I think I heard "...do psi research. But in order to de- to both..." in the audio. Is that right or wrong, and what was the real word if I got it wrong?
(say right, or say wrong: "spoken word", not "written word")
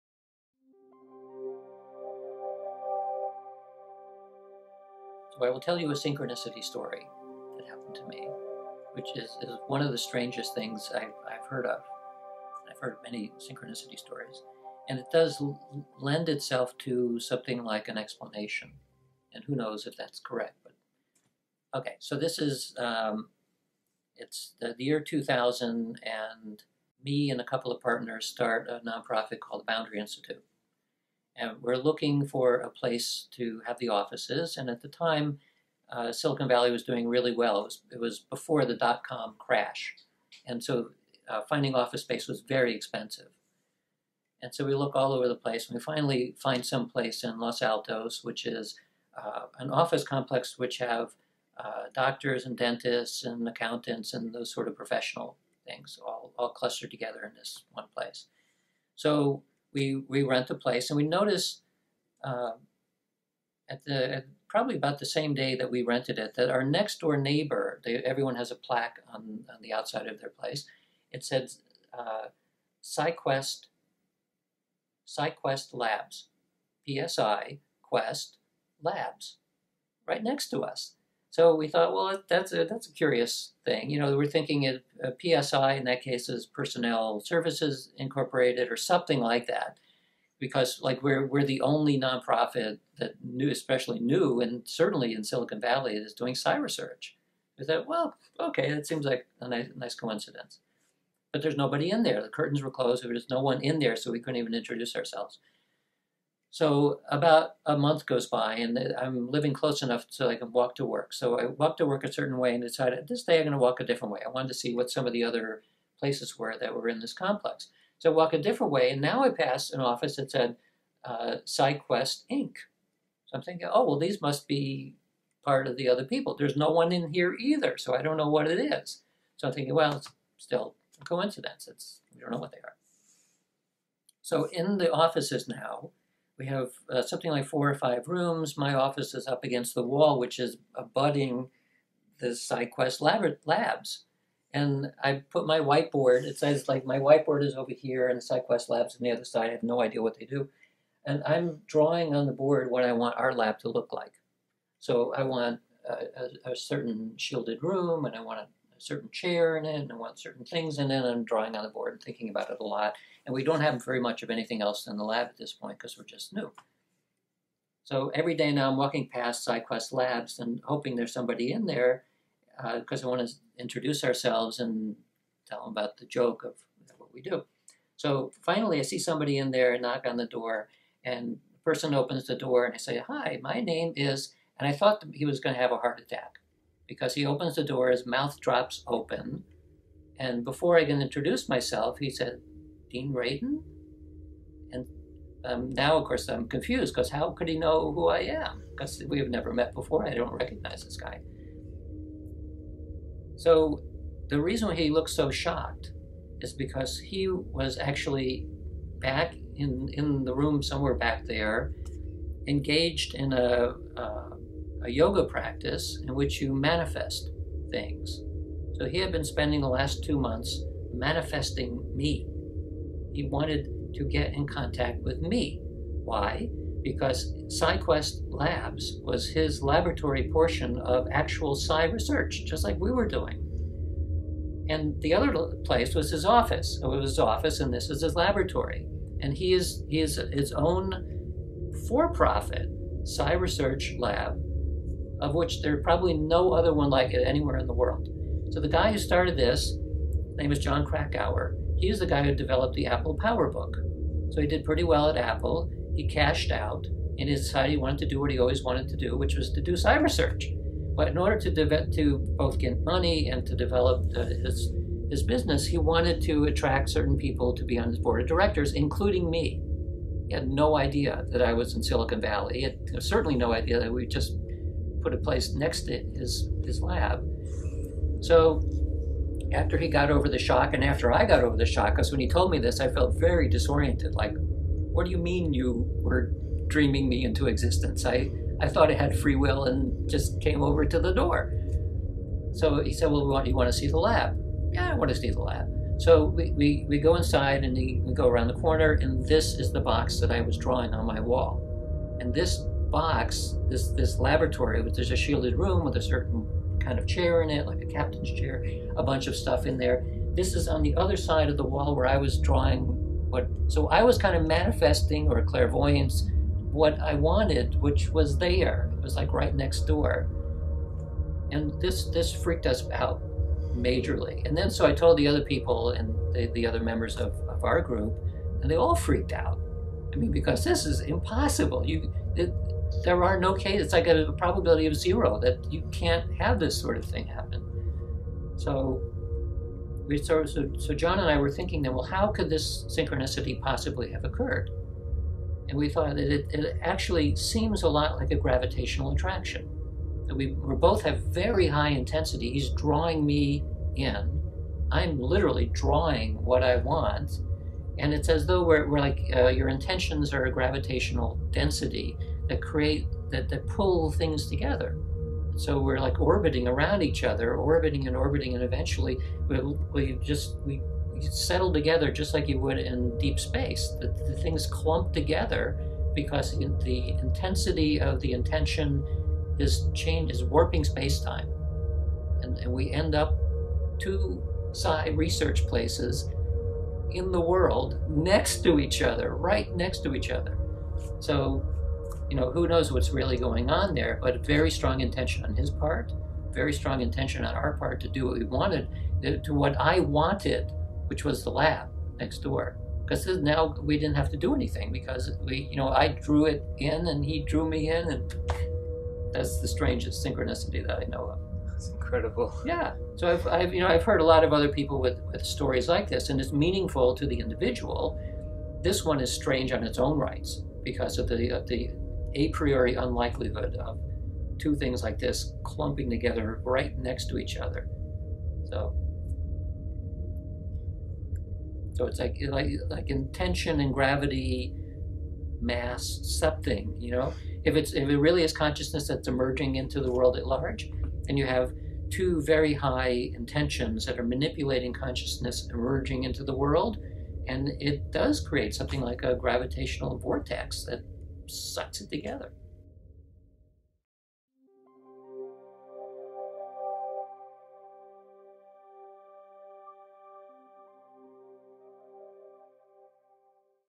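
right.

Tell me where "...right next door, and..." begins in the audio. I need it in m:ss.
5:19.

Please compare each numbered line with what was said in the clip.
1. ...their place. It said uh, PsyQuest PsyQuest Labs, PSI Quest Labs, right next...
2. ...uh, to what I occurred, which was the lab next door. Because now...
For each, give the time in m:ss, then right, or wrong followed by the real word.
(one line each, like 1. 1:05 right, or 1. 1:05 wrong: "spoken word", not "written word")
1. 1:10 right
2. 6:39 wrong: "wanted", not "occurred".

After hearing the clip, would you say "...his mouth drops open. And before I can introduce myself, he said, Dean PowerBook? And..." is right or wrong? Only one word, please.
wrong.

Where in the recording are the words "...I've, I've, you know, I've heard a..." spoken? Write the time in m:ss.
6:53.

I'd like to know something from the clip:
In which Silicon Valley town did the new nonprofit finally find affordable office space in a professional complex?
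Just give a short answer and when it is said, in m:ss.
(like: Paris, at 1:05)
Los Altos, at 0:47.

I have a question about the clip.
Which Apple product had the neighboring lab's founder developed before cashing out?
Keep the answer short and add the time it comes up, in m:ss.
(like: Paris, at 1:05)
PowerBook, at 4:12.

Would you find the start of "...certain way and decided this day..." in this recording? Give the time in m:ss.
1:52.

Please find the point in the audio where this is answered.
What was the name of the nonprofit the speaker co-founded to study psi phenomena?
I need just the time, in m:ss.
0:29.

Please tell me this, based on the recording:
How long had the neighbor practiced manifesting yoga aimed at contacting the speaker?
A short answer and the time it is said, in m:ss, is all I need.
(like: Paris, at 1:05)
2 months, at 3:40.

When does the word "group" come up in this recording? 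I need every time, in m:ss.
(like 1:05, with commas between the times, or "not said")
5:27.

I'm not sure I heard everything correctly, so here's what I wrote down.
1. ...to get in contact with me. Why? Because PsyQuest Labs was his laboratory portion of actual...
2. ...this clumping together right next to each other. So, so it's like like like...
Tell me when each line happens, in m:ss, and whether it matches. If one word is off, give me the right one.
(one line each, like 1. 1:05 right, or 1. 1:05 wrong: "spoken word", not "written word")
1. 3:43 right
2. 7:05 right.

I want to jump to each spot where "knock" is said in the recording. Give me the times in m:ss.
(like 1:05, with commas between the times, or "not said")
2:59.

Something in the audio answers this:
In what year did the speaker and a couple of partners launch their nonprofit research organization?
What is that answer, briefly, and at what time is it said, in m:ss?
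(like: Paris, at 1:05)
2000, at 0:24.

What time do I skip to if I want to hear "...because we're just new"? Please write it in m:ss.
2:45.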